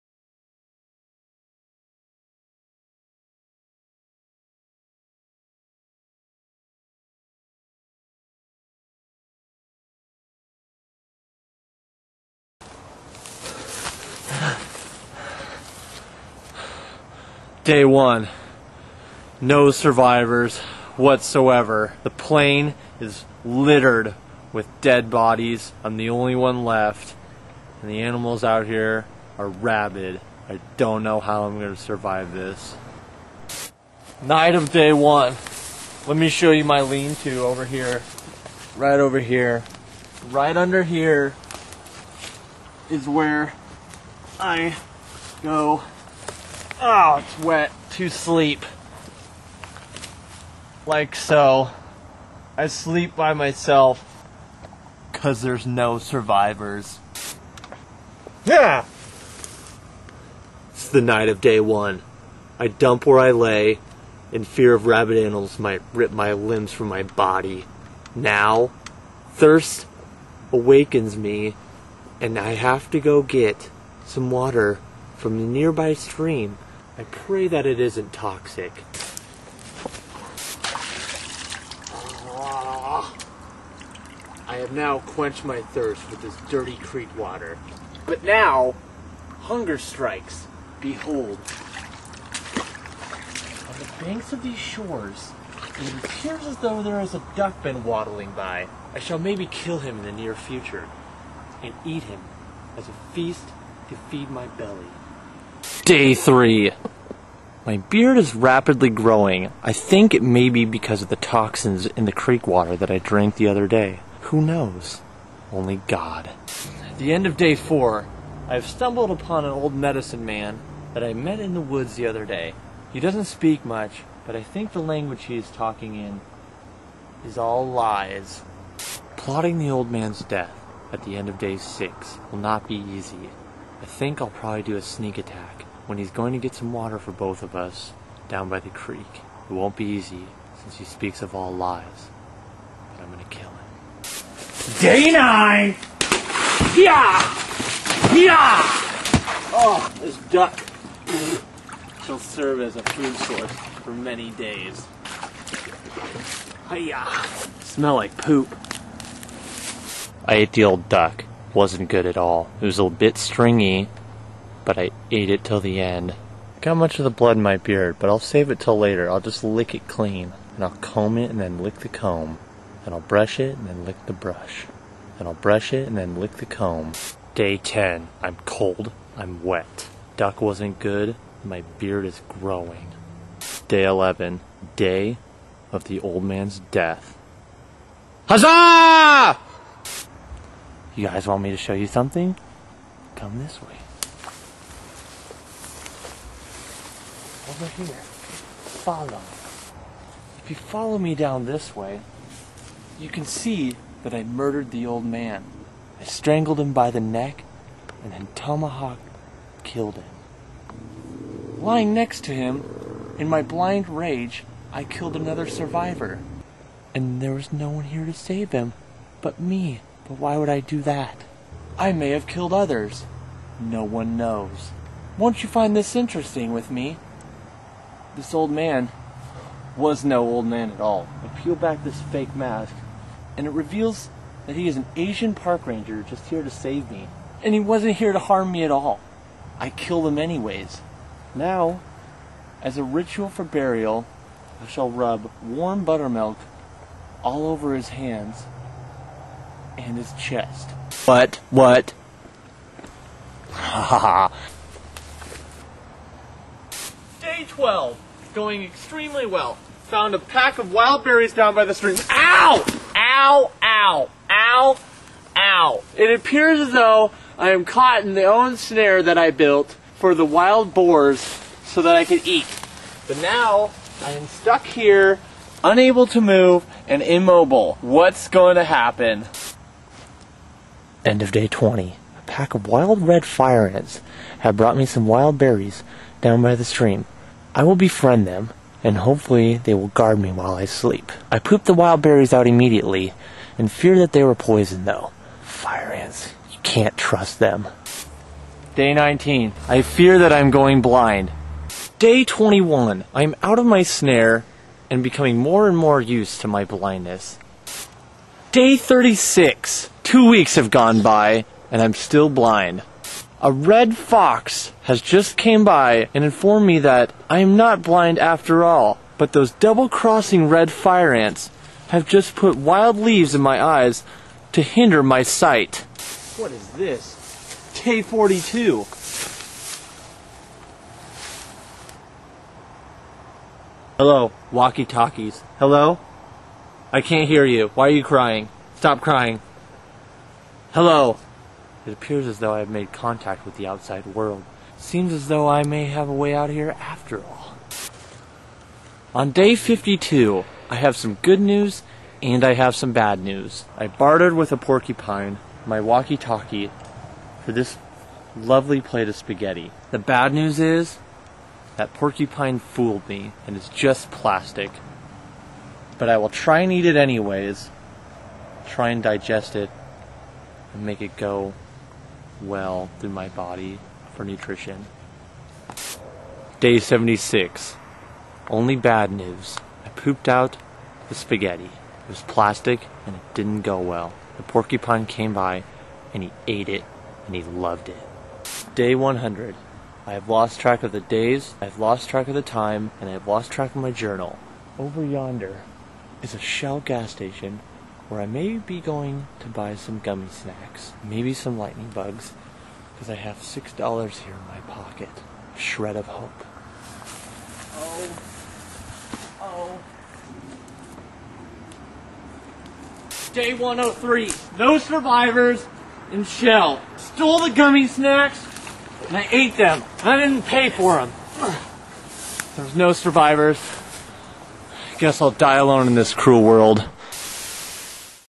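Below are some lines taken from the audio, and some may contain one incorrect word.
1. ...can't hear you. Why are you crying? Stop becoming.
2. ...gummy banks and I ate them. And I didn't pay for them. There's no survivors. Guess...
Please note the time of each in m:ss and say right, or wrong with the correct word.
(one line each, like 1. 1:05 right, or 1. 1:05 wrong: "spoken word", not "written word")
1. 5:36 wrong: "crying", not "becoming"
2. 6:57 wrong: "snacks", not "banks".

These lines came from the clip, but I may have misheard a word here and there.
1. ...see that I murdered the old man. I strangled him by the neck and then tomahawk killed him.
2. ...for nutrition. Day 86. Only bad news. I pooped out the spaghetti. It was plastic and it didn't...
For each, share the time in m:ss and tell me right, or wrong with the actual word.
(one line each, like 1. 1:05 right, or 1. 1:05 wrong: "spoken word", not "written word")
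1. 3:23 right
2. 6:14 wrong: "76", not "86".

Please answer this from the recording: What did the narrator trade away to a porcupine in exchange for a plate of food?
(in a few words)
Walkie talkie.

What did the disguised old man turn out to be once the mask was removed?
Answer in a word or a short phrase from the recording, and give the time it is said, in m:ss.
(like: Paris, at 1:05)
Park ranger, at 3:55.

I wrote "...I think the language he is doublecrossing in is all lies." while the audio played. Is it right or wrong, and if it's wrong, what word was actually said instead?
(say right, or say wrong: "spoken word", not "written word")
wrong: "talking", not "doublecrossing".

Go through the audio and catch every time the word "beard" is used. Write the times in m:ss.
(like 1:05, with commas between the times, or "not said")
1:47, 2:47, 3:01.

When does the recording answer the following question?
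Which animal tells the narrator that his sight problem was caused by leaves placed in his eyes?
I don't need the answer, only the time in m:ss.
5:13.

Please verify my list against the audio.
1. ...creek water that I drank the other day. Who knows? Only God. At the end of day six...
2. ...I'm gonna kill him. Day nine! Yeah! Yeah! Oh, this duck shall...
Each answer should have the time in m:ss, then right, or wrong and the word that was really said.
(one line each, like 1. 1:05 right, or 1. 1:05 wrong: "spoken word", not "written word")
1. 1:52 wrong: "four", not "six"
2. 2:23 right.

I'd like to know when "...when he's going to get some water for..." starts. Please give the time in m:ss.
2:15.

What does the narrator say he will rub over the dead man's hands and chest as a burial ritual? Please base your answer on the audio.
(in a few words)
Warm buttermilk.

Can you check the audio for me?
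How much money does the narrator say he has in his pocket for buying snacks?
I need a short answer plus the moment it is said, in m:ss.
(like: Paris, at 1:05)
$6, at 6:43.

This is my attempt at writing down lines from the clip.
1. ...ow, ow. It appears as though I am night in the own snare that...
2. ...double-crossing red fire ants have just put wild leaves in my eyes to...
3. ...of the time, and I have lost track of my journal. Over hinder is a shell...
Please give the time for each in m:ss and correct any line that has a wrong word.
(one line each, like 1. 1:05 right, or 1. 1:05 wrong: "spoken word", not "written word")
1. 4:24 wrong: "caught", not "night"
2. 5:19 right
3. 6:32 wrong: "yonder", not "hinder".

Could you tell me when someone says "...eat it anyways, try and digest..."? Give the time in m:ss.
6:06.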